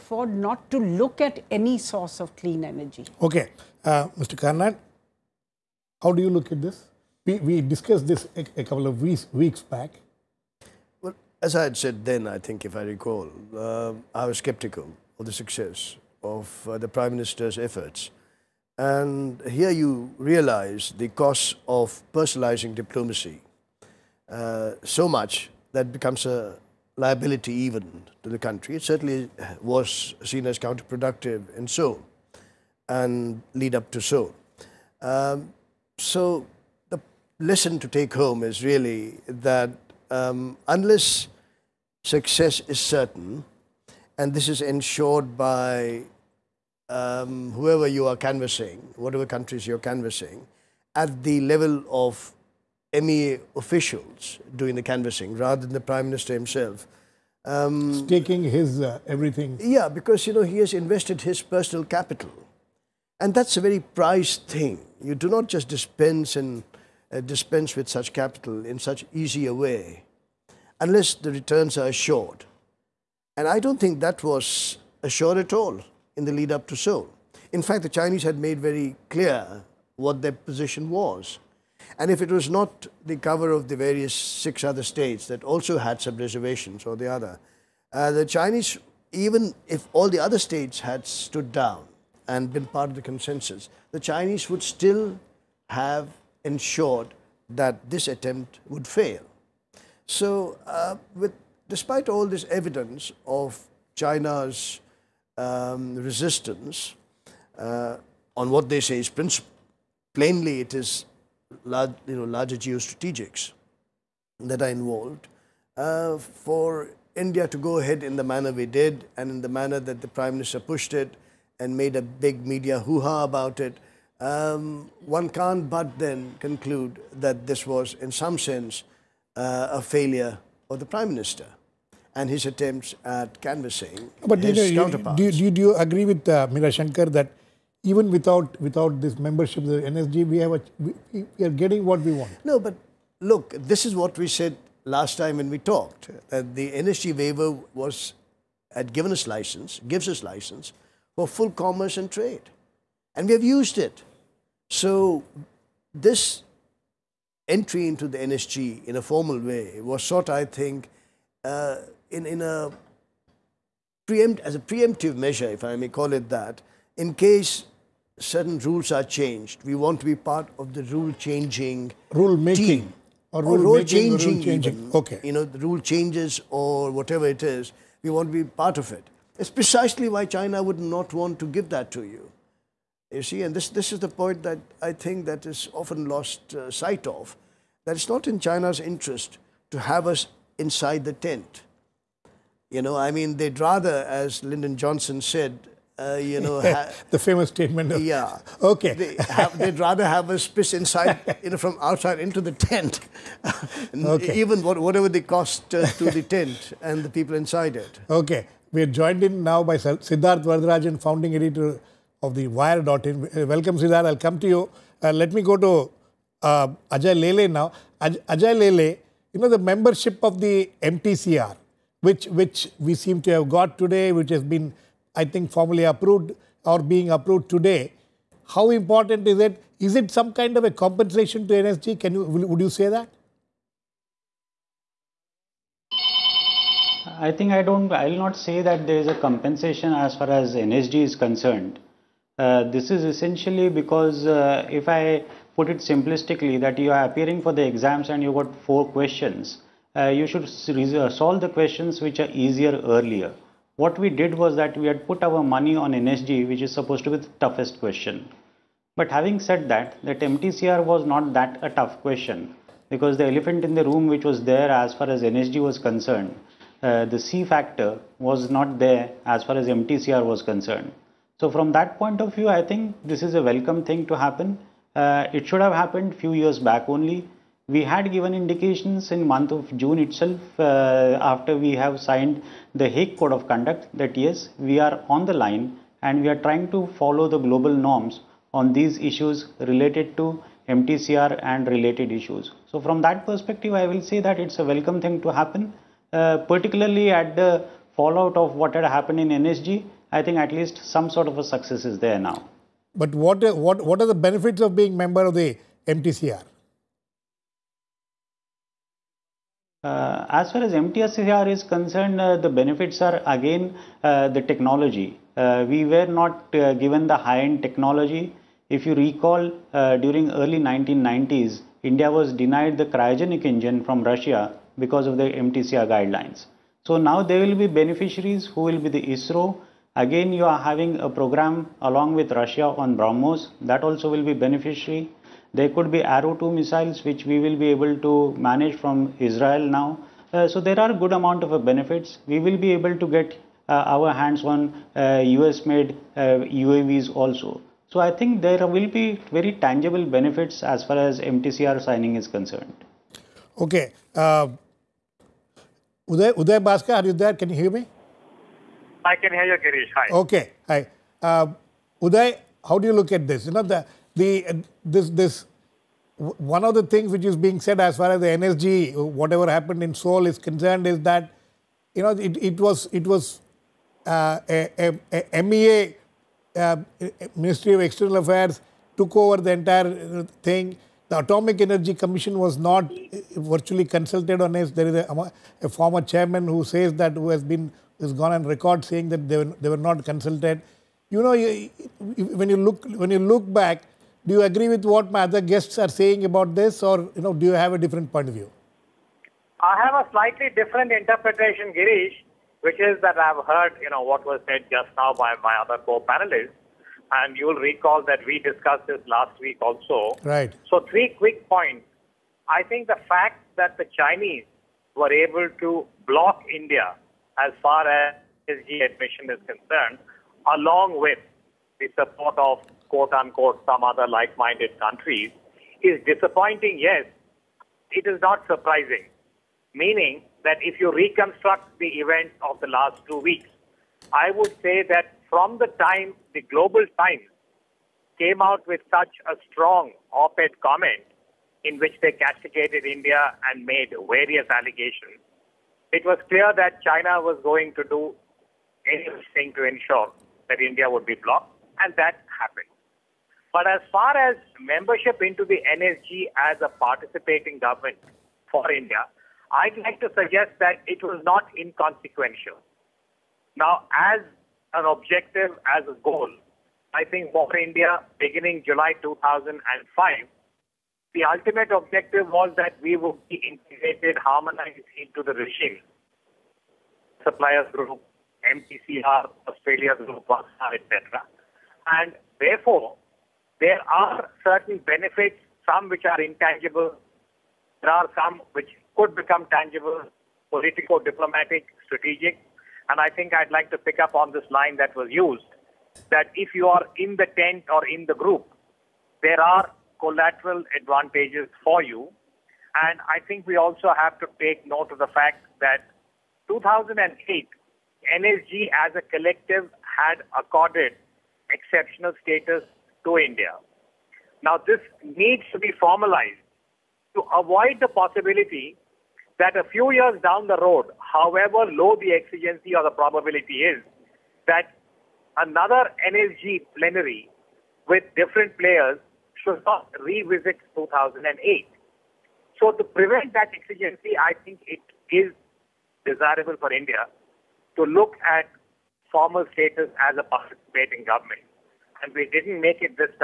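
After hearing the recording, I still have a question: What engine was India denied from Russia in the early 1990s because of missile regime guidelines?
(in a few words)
Cryogenic engine.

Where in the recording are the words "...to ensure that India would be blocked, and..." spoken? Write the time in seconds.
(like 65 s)
449 s.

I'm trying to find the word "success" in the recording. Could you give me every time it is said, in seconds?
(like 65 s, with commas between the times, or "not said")
15 s, 42 s, 301 s.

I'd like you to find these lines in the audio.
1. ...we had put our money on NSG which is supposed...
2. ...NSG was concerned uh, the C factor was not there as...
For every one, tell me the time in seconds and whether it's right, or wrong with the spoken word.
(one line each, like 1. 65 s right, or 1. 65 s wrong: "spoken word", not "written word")
1. 254 s right
2. 265 s right.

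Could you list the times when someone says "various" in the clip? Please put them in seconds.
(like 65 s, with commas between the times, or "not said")
83 s, 444 s.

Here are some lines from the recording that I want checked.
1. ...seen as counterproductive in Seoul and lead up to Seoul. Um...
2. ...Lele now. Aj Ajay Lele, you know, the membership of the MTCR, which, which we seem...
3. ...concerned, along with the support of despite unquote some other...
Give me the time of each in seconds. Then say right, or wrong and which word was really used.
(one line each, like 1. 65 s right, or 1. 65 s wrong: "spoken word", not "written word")
1. 30 s right
2. 217 s right
3. 419 s wrong: "quote", not "despite".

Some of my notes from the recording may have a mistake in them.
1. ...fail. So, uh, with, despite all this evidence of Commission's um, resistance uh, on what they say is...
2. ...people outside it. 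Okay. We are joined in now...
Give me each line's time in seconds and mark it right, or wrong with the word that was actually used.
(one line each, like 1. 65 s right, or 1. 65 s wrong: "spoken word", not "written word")
1. 98 s wrong: "China", not "Commission"
2. 207 s wrong: "inside", not "outside".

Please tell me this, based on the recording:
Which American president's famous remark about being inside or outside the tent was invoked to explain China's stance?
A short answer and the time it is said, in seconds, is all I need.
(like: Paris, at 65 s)
Lyndon Johnson, at 194 s.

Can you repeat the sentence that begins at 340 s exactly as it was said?
Uh, so there are good amount of benefits.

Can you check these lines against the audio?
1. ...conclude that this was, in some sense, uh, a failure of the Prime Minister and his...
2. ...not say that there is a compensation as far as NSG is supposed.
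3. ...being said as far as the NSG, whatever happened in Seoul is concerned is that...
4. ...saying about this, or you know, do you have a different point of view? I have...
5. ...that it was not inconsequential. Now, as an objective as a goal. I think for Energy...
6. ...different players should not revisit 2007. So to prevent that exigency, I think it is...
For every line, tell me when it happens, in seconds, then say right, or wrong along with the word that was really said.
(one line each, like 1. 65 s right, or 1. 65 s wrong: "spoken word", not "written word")
1. 126 s right
2. 238 s wrong: "concerned", not "supposed"
3. 367 s right
4. 395 s right
5. 460 s wrong: "India", not "Energy"
6. 528 s wrong: "2008", not "2007".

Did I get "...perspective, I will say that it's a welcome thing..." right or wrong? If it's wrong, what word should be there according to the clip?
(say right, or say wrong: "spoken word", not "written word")
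right.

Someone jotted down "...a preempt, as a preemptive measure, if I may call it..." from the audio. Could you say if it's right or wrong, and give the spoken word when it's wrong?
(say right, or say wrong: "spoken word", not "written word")
right.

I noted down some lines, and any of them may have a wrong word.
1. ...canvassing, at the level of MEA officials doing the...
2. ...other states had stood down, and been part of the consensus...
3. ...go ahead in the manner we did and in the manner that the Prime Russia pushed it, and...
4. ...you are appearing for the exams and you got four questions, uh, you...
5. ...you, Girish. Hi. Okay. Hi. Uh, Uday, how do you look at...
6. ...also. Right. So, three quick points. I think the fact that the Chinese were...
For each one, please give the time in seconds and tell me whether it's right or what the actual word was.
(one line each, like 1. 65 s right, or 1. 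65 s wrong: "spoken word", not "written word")
1. 49 s right
2. 90 s right
3. 117 s wrong: "Minister", not "Russia"
4. 246 s right
5. 359 s right
6. 409 s right.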